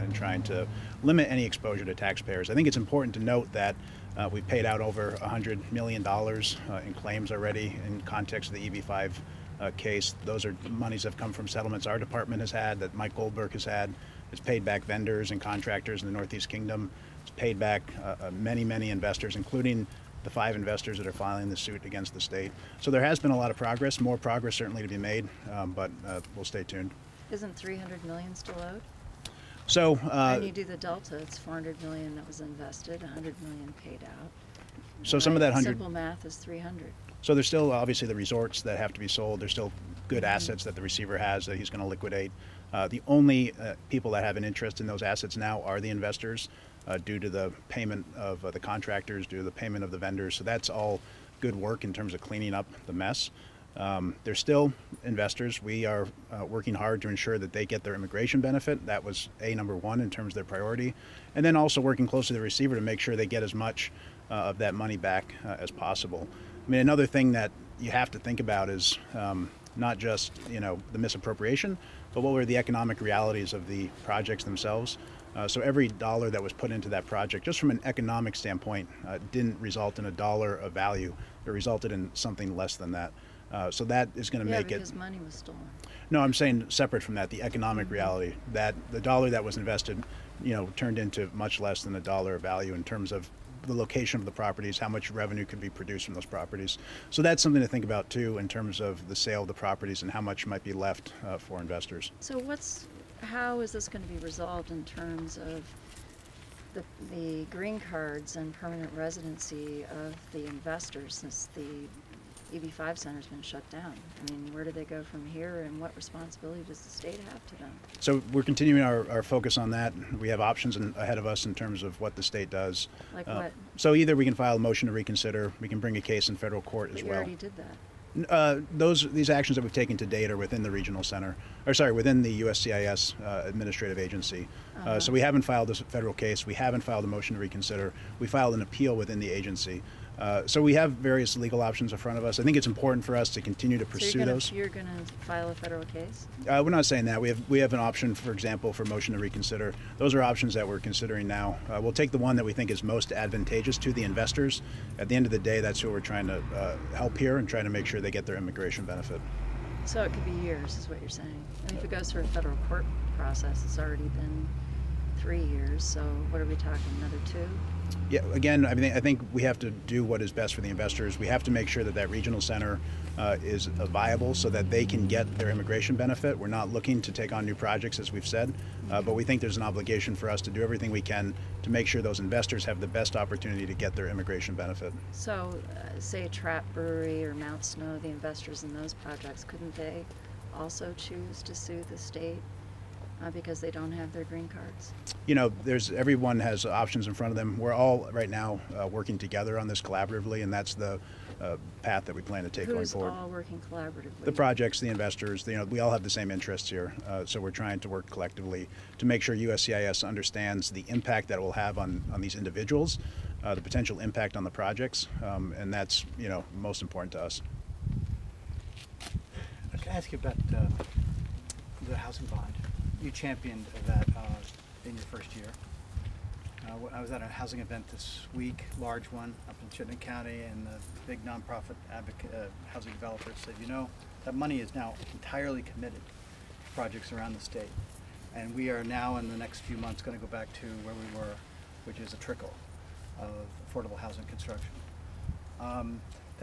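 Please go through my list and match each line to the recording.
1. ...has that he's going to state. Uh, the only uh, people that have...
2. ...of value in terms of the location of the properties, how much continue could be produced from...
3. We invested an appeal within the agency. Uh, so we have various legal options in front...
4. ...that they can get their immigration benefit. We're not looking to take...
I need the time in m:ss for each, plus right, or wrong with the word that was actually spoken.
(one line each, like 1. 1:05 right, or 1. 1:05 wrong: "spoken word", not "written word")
1. 0:41 wrong: "liquidate", not "state"
2. 1:32 wrong: "revenue", not "continue"
3. 2:18 wrong: "filed", not "invested"
4. 2:54 right.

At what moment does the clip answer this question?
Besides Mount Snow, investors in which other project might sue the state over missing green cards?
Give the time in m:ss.
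3:06.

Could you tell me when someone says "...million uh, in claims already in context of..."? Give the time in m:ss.
0:05.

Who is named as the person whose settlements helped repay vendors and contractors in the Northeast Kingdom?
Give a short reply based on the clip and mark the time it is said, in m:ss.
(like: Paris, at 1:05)
Mike Goldberg, at 0:12.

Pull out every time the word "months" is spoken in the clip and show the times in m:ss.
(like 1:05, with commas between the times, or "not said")
3:59.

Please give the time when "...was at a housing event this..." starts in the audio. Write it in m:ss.
3:46.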